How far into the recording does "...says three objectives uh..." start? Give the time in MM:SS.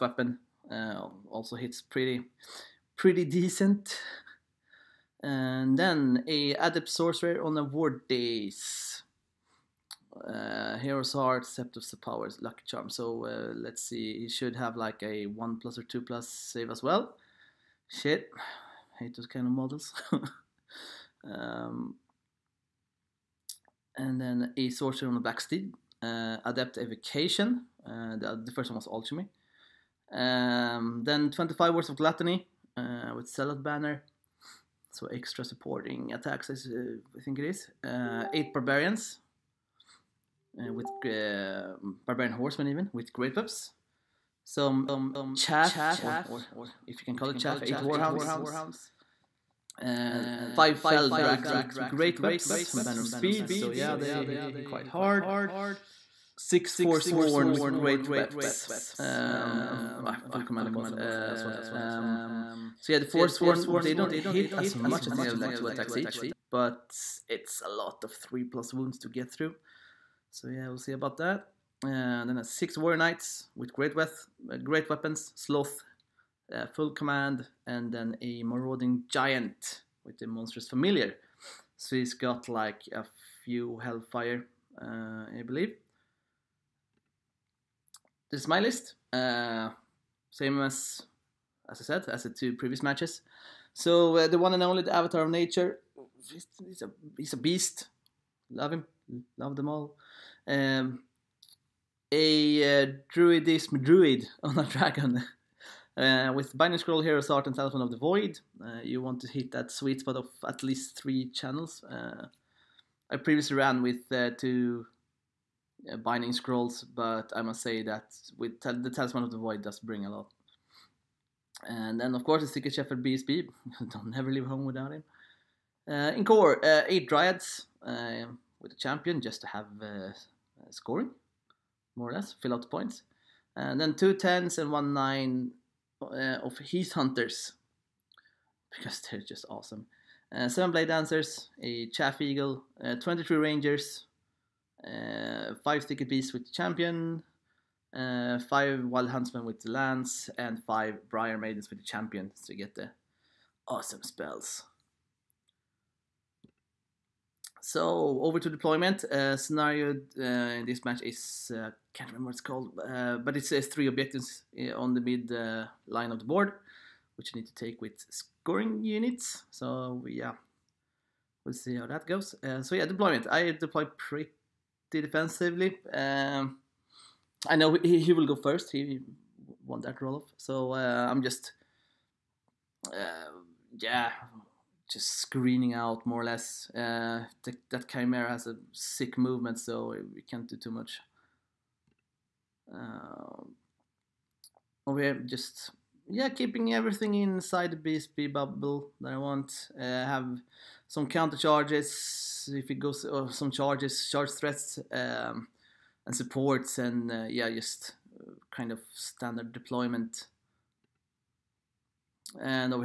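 02:43.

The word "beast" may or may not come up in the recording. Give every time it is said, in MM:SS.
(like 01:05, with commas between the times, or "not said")
01:37, 02:26.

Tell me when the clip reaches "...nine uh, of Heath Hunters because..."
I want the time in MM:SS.
02:14.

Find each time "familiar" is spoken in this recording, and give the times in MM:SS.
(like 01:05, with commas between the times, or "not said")
01:20.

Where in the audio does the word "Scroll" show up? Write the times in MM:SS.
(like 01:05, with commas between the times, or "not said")
01:46, 01:56.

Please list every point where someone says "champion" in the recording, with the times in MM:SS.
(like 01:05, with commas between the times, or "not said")
02:08, 02:26, 02:31.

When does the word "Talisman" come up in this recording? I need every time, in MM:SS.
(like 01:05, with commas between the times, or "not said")
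01:47, 01:58.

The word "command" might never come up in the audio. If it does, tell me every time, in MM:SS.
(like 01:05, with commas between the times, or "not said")
01:00, 01:16.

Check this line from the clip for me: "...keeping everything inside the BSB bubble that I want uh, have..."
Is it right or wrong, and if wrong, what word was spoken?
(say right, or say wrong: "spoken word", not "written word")
right.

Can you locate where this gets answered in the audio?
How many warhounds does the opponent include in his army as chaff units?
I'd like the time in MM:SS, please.
00:47.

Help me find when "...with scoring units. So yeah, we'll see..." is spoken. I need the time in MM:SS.
02:47.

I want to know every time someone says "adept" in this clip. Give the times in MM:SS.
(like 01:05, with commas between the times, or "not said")
00:06, 00:26.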